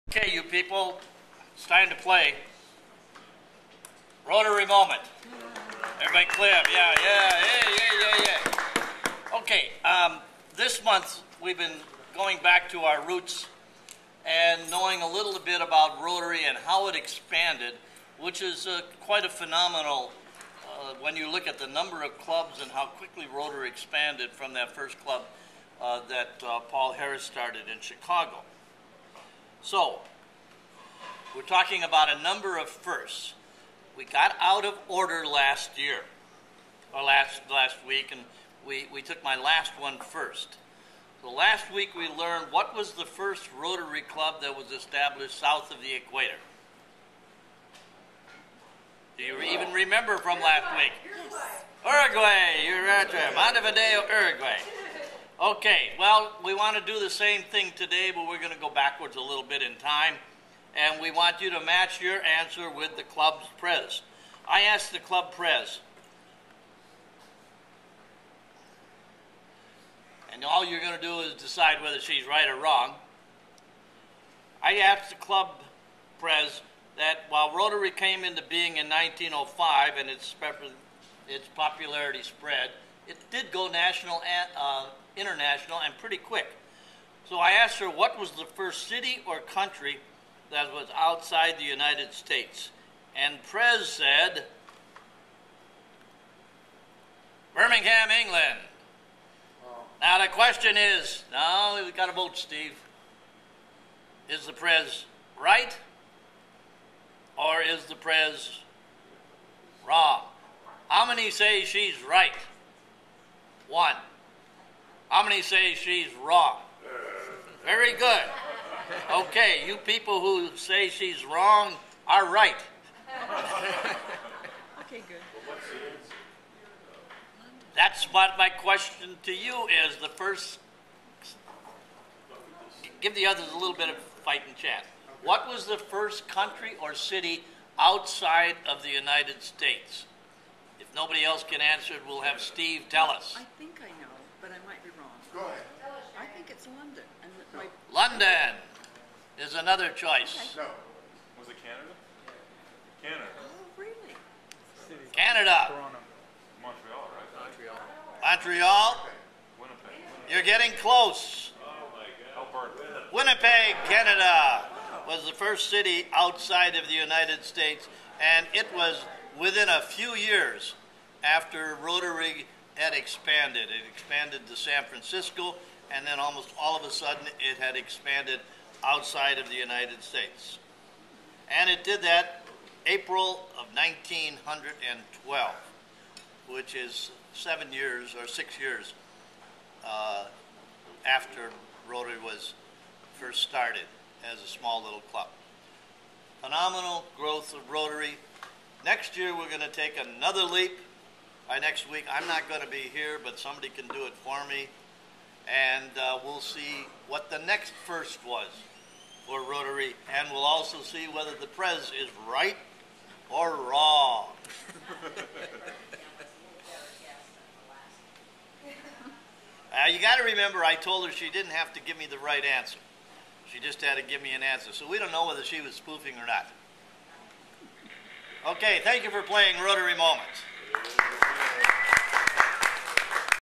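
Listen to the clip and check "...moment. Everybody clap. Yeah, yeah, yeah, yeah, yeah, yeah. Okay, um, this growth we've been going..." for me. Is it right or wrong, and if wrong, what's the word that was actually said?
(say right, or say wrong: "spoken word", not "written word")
wrong: "month", not "growth".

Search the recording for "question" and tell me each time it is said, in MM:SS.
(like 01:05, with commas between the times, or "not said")
01:40, 02:08.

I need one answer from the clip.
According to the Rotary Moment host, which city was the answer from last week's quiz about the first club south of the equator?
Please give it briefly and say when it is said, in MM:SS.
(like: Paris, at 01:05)
Montevideo, Uruguay, at 00:53.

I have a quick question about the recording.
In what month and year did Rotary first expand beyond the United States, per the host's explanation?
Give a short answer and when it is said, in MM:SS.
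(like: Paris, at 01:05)
April 1912, at 03:02.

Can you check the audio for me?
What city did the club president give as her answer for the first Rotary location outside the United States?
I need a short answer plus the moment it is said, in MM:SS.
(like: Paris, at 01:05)
Birmingham, England, at 01:37.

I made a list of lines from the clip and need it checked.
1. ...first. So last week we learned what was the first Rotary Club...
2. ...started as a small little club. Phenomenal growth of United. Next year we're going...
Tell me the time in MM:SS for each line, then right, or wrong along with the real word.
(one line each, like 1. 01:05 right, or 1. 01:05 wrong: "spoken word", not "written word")
1. 00:39 right
2. 03:13 wrong: "Rotary", not "United".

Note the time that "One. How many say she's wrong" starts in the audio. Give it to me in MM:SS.
01:53.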